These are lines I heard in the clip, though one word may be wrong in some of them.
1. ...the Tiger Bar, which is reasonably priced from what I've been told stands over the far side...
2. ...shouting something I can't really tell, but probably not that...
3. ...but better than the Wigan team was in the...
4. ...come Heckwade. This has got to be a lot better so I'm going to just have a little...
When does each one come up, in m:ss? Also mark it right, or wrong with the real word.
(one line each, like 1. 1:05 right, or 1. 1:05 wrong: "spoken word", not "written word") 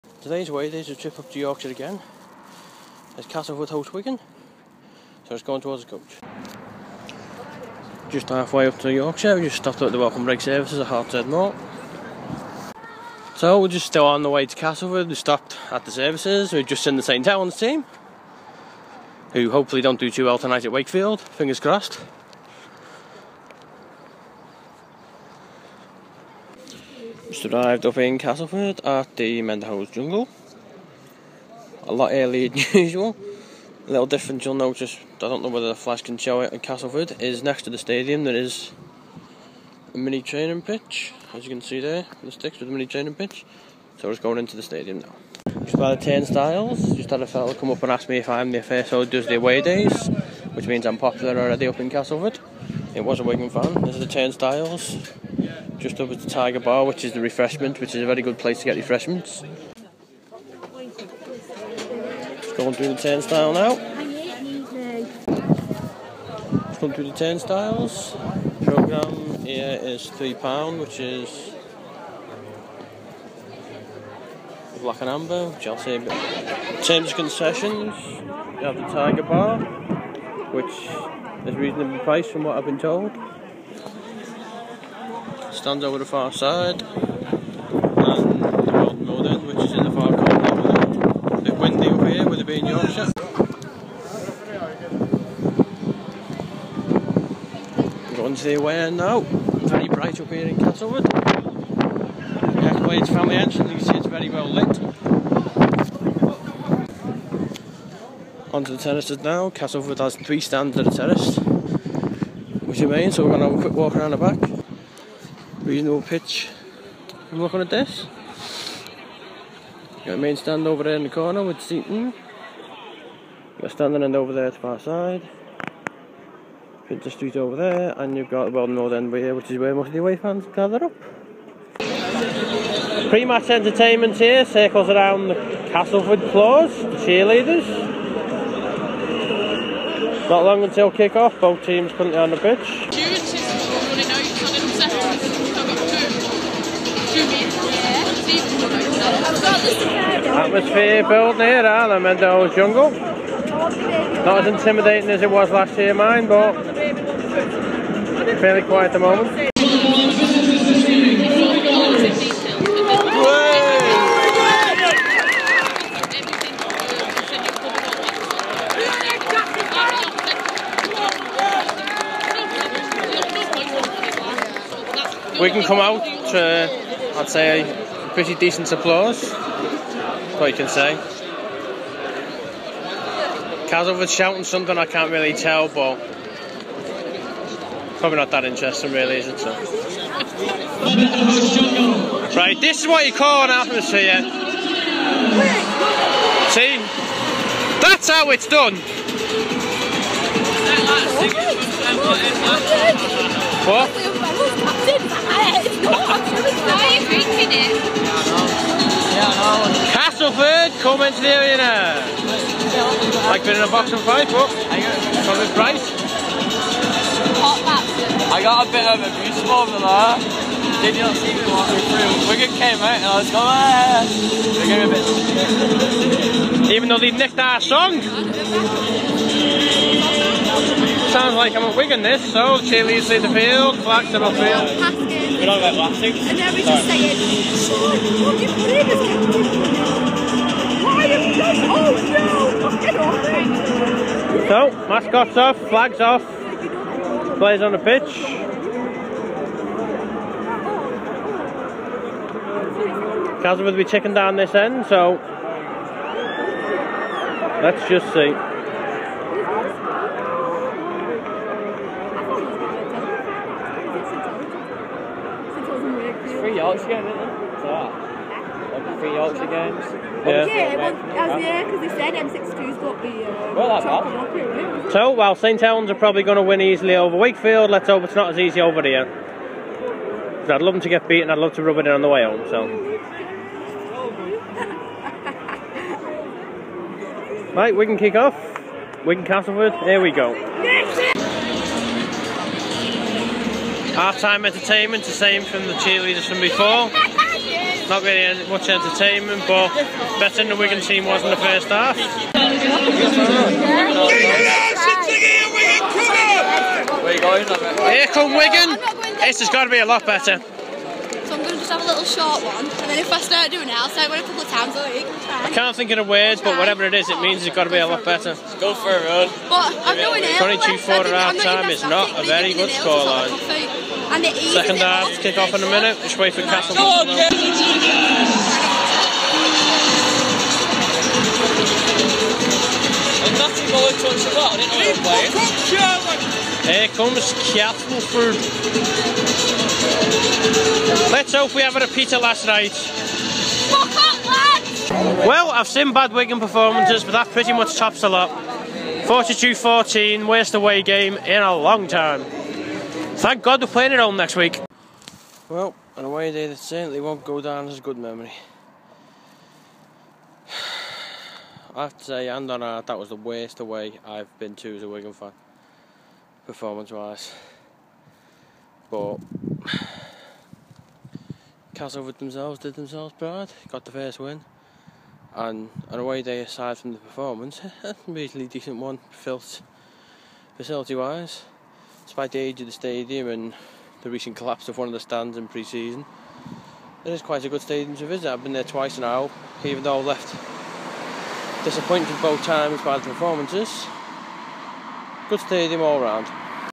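1. 1:18 right
2. 3:04 right
3. 4:59 right
4. 5:08 wrong: "Wigan", not "Heckwade".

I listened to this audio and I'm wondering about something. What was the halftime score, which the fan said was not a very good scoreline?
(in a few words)
22-4.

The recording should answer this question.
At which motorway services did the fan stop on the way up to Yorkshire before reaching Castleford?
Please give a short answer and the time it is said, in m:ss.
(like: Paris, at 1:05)
Hartshead Moor, at 0:10.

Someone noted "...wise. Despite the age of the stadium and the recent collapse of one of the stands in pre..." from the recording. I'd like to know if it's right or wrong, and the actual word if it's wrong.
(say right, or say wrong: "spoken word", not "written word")
right.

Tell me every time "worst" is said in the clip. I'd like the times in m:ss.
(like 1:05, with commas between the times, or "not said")
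5:50, 6:03.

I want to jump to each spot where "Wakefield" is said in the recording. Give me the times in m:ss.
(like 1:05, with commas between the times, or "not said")
0:20, 4:37.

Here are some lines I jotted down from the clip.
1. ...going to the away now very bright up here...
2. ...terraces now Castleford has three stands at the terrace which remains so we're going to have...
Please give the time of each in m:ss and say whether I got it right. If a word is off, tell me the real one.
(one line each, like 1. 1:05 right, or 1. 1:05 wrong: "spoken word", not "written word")
1. 1:38 right
2. 1:48 right.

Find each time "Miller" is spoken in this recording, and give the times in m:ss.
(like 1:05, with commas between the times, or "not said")
not said.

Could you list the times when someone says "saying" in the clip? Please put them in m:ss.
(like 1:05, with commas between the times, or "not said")
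3:56.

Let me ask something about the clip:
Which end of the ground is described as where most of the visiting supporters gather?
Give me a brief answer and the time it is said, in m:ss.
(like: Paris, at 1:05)
Wheldon North end, at 2:08.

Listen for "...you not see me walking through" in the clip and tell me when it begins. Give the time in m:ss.
3:40.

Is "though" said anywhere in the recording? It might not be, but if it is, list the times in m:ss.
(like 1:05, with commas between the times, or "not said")
3:46, 6:29.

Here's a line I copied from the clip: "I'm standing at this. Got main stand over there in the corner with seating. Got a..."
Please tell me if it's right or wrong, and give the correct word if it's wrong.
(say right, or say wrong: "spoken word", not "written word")
wrong: "looking", not "standing".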